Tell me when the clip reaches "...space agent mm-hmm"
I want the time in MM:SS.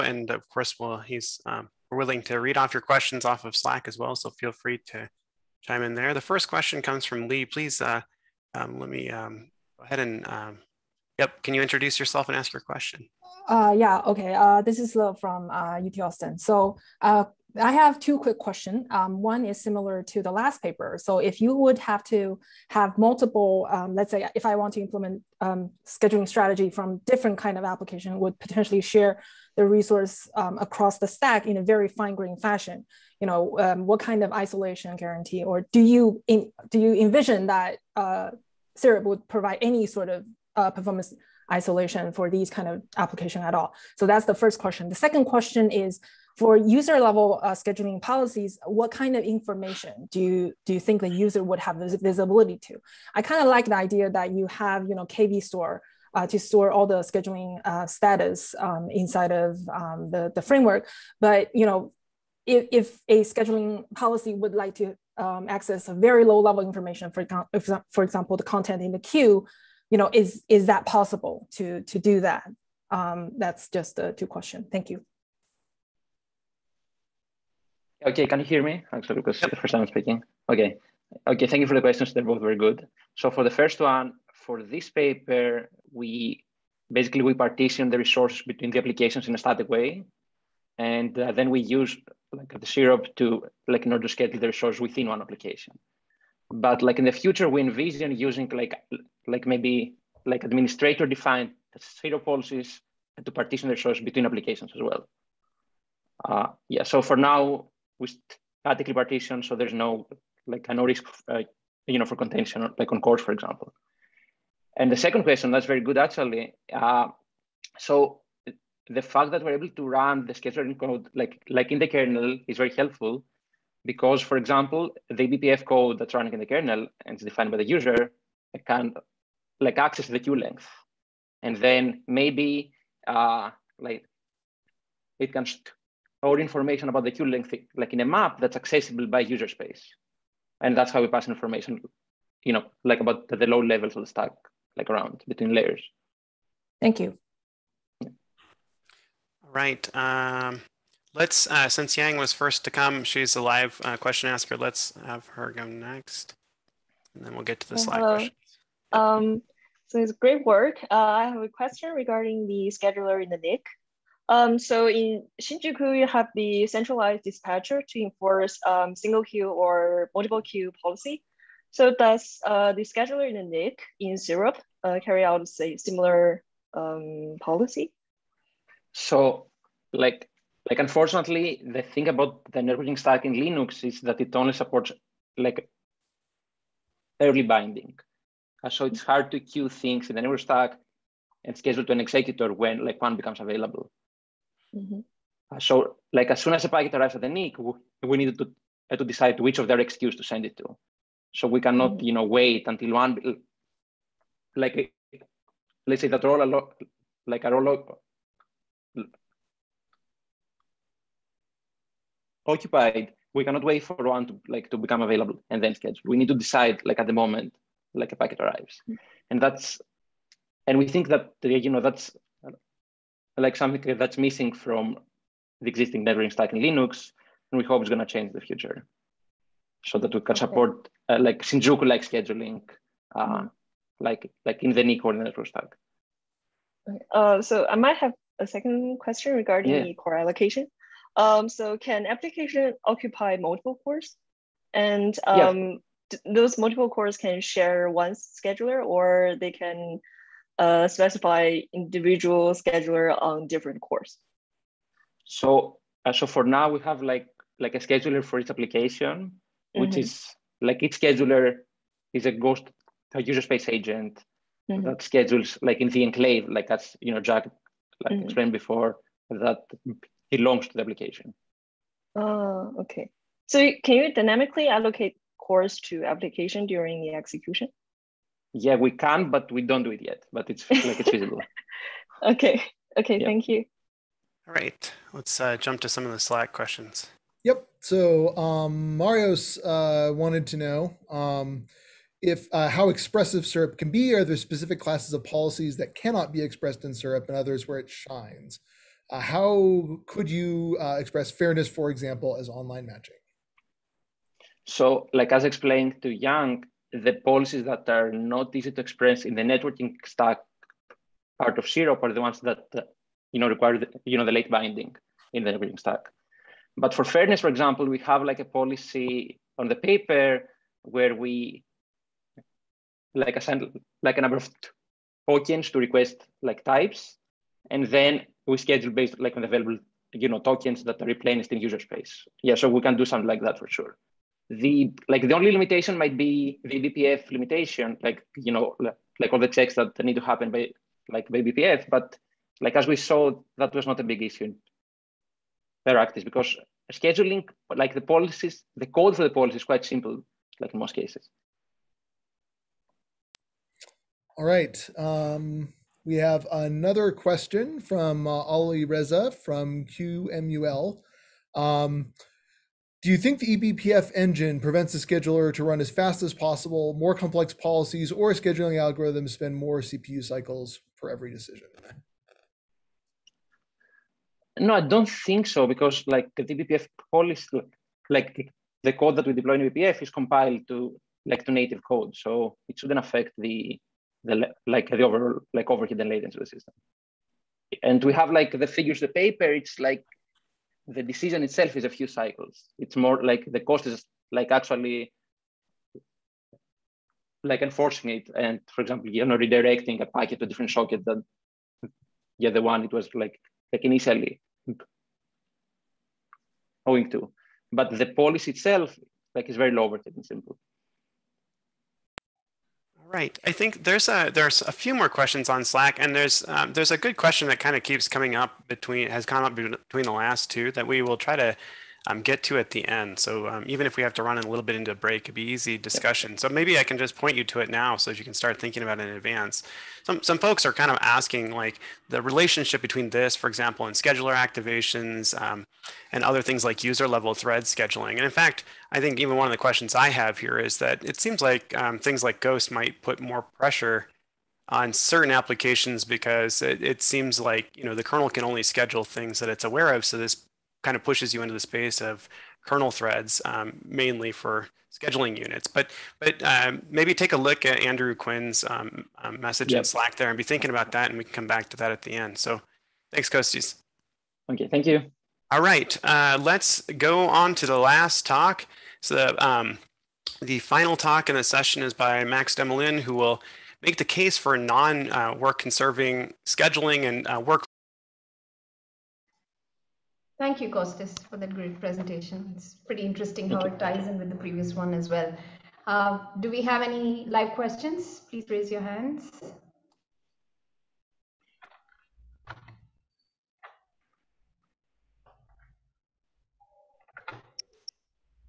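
04:23.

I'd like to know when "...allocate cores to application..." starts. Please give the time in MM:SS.
04:34.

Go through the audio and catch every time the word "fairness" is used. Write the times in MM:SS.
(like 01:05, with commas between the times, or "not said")
05:01, 05:17.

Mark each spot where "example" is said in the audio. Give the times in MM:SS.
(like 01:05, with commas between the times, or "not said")
01:08, 01:53, 02:04, 05:01, 05:17, 06:38, 07:13.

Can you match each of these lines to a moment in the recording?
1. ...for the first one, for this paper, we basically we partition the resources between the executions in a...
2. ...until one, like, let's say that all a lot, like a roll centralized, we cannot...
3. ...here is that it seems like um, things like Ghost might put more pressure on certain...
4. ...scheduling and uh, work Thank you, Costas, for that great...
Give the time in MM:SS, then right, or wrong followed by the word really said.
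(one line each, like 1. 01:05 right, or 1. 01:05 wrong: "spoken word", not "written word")
1. 01:23 wrong: "applications", not "executions"
2. 03:22 wrong: "occupied", not "centralized"
3. 07:20 right
4. 07:56 right.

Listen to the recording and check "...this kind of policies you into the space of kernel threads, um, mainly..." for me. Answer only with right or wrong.
wrong.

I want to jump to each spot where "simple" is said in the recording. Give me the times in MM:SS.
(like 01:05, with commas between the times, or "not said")
05:49, 06:50.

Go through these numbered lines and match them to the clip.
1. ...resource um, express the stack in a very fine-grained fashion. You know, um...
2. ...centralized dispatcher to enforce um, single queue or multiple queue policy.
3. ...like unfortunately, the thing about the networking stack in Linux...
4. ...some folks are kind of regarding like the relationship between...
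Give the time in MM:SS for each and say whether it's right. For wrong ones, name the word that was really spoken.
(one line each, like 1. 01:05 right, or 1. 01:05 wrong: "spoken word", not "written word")
1. 00:29 wrong: "across", not "express"
2. 02:46 right
3. 03:00 right
4. 07:10 wrong: "asking", not "regarding".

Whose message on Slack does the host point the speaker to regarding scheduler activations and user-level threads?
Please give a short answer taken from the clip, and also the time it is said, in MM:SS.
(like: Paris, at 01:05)
Andrew Quinn, at 07:37.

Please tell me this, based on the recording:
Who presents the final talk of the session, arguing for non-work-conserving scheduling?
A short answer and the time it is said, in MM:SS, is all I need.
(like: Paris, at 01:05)
Max Demoulin, at 07:52.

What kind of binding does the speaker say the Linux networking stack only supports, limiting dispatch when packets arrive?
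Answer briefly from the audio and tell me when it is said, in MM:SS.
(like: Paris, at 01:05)
Early binding, at 03:07.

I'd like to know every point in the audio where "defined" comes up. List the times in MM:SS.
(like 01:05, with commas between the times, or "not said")
01:41, 02:07.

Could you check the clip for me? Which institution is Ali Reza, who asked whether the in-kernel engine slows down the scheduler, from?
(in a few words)
QMUL.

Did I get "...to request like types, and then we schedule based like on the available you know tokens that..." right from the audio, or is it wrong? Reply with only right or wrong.
right.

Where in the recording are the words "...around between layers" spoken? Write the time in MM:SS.
02:24.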